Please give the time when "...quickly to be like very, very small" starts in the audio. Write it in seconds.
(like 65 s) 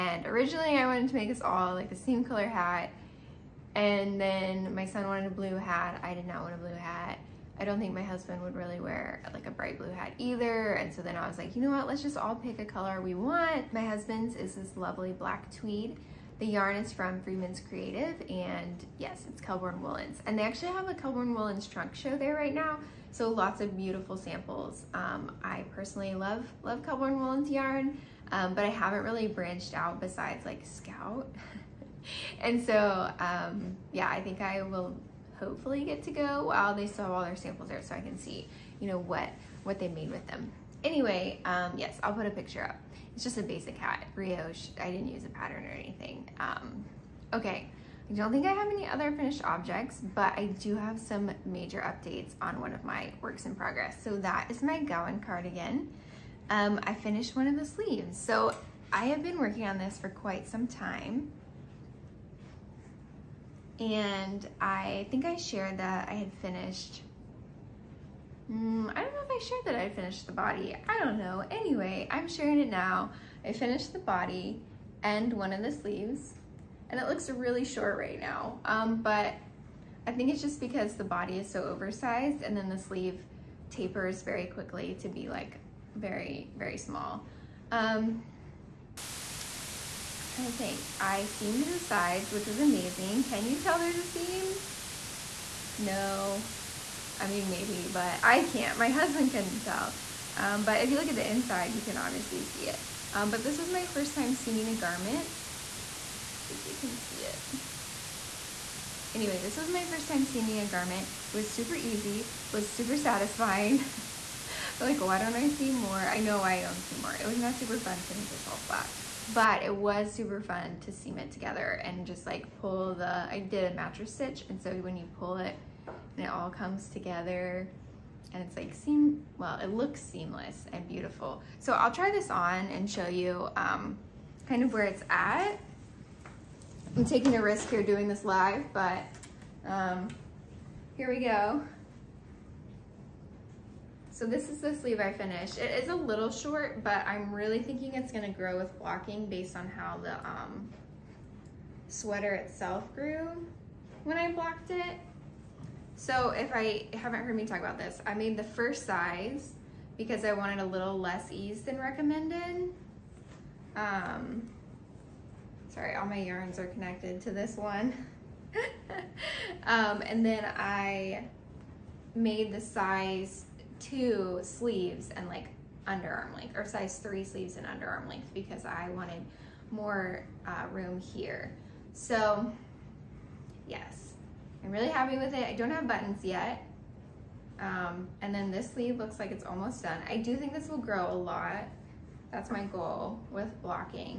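84 s.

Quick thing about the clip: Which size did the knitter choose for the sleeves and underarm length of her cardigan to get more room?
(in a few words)
Size 3.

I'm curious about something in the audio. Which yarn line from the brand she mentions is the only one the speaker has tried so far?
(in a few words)
Scout.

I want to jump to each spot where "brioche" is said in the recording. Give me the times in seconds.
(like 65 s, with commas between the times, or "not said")
44 s.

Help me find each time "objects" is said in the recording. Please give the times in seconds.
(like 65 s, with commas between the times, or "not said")
49 s.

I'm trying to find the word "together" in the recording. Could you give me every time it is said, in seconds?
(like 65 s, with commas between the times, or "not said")
121 s, 126 s.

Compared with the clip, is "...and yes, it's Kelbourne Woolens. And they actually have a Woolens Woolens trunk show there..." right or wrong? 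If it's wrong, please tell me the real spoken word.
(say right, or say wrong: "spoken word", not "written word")
wrong: "Kelbourne", not "Woolens".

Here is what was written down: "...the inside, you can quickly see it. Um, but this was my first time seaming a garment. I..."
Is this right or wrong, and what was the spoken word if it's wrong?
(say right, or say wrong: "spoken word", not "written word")
wrong: "obviously", not "quickly".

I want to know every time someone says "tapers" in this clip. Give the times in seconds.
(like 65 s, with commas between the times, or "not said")
83 s.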